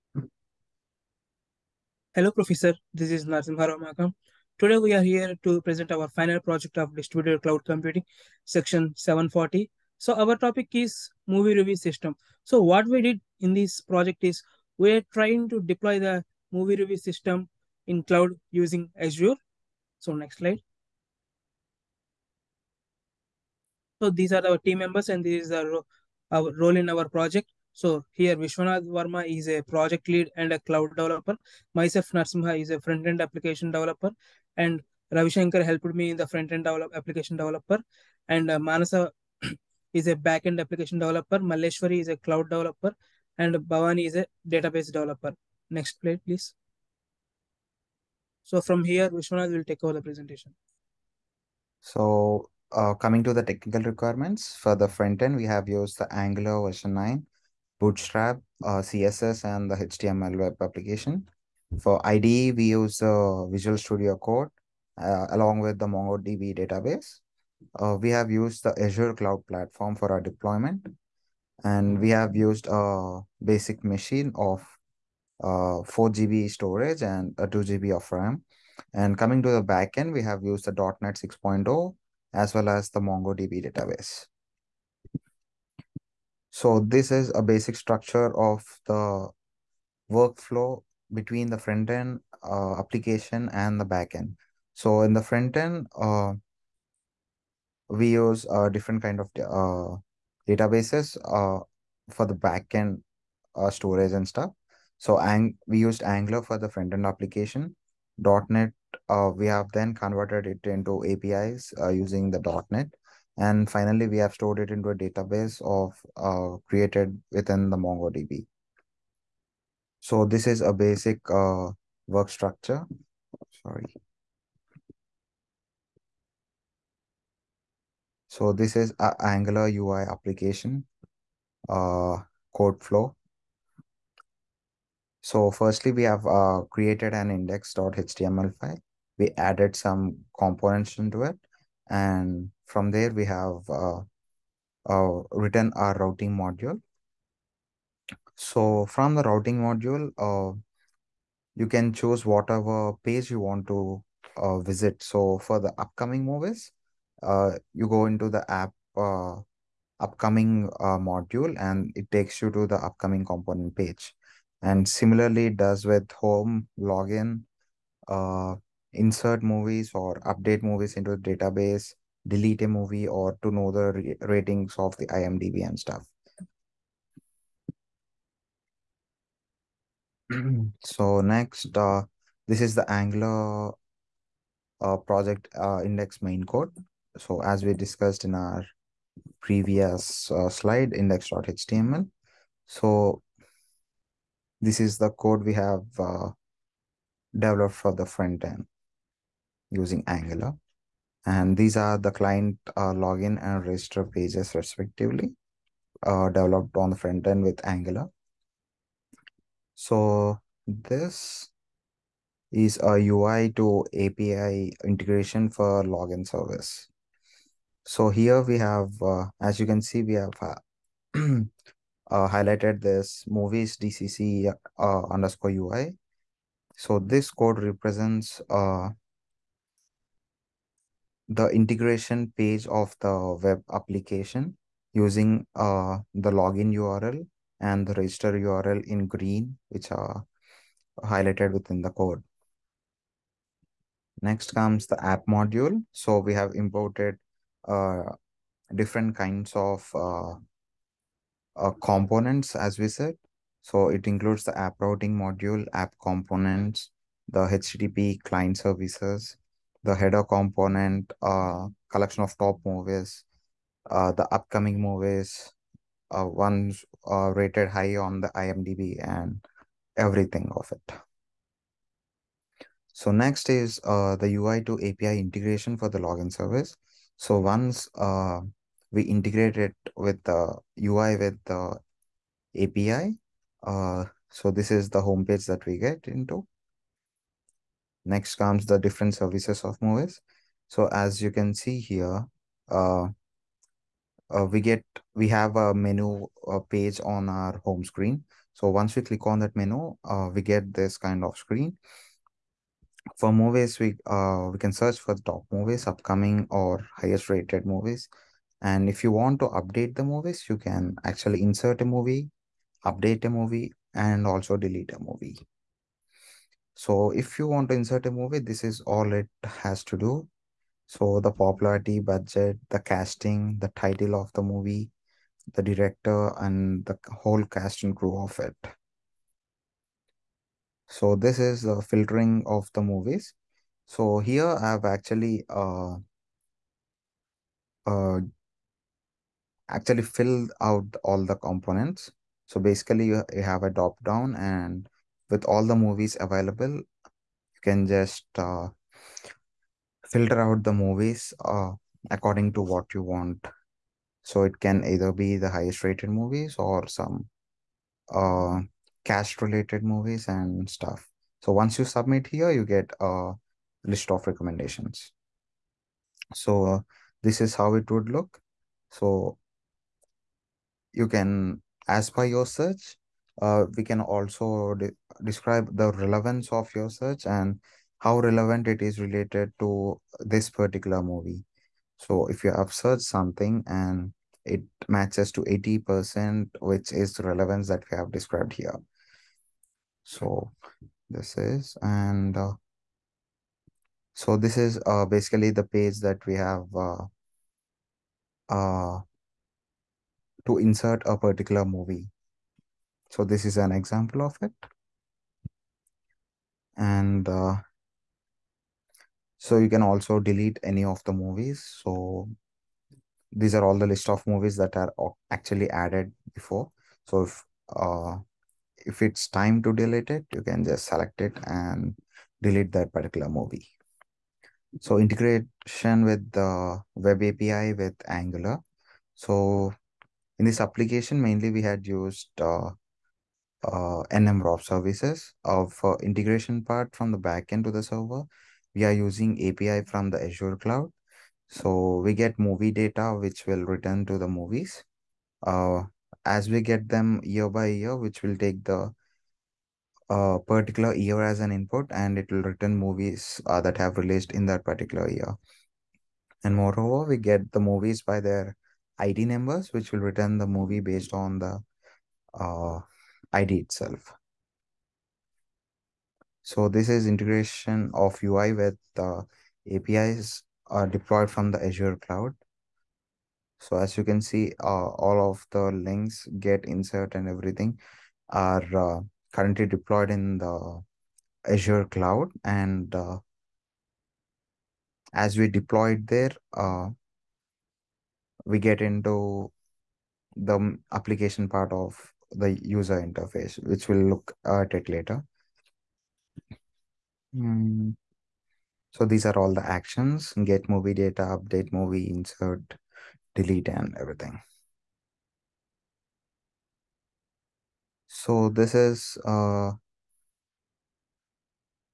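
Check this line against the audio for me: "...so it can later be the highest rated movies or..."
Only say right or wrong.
wrong.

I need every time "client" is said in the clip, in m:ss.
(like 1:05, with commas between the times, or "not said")
3:22, 4:18.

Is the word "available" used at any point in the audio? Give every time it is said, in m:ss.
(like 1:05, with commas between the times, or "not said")
5:46.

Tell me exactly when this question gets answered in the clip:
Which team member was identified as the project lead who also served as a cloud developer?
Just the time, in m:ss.
0:28.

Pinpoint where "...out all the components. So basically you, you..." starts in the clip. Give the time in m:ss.
5:40.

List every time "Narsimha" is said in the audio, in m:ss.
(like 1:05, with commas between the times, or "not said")
0:03, 0:32.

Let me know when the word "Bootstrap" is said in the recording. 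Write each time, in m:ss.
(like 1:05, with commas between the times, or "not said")
0:57.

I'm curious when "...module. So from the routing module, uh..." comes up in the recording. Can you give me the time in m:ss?
2:26.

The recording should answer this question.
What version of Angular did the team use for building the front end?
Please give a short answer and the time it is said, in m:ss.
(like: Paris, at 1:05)
9, at 0:56.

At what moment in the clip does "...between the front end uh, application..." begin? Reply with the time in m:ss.
1:31.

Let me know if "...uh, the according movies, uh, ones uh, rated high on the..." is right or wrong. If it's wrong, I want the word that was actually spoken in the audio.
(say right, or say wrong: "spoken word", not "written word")
wrong: "upcoming", not "according".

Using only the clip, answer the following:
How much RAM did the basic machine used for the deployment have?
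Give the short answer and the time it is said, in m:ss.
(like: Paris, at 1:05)
2 GB, at 1:17.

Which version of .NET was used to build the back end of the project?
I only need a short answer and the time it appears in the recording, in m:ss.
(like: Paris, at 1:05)
6.0, at 1:21.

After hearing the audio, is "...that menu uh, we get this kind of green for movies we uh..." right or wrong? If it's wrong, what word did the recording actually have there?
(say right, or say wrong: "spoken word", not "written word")
wrong: "screen", not "green".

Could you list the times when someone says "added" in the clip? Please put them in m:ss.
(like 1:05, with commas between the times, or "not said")
2:19, 6:55.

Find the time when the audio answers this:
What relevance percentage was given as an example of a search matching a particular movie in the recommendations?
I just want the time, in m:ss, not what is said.
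6:25.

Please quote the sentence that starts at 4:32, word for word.
So next is uh, the UI to API integration for the login service.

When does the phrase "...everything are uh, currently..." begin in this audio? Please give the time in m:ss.
7:57.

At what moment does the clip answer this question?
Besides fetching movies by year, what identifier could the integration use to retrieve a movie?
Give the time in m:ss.
7:38.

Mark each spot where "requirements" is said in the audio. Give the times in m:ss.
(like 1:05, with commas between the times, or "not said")
0:53.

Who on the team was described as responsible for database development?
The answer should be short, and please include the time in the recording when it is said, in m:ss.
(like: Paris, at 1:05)
Bhavani, at 0:43.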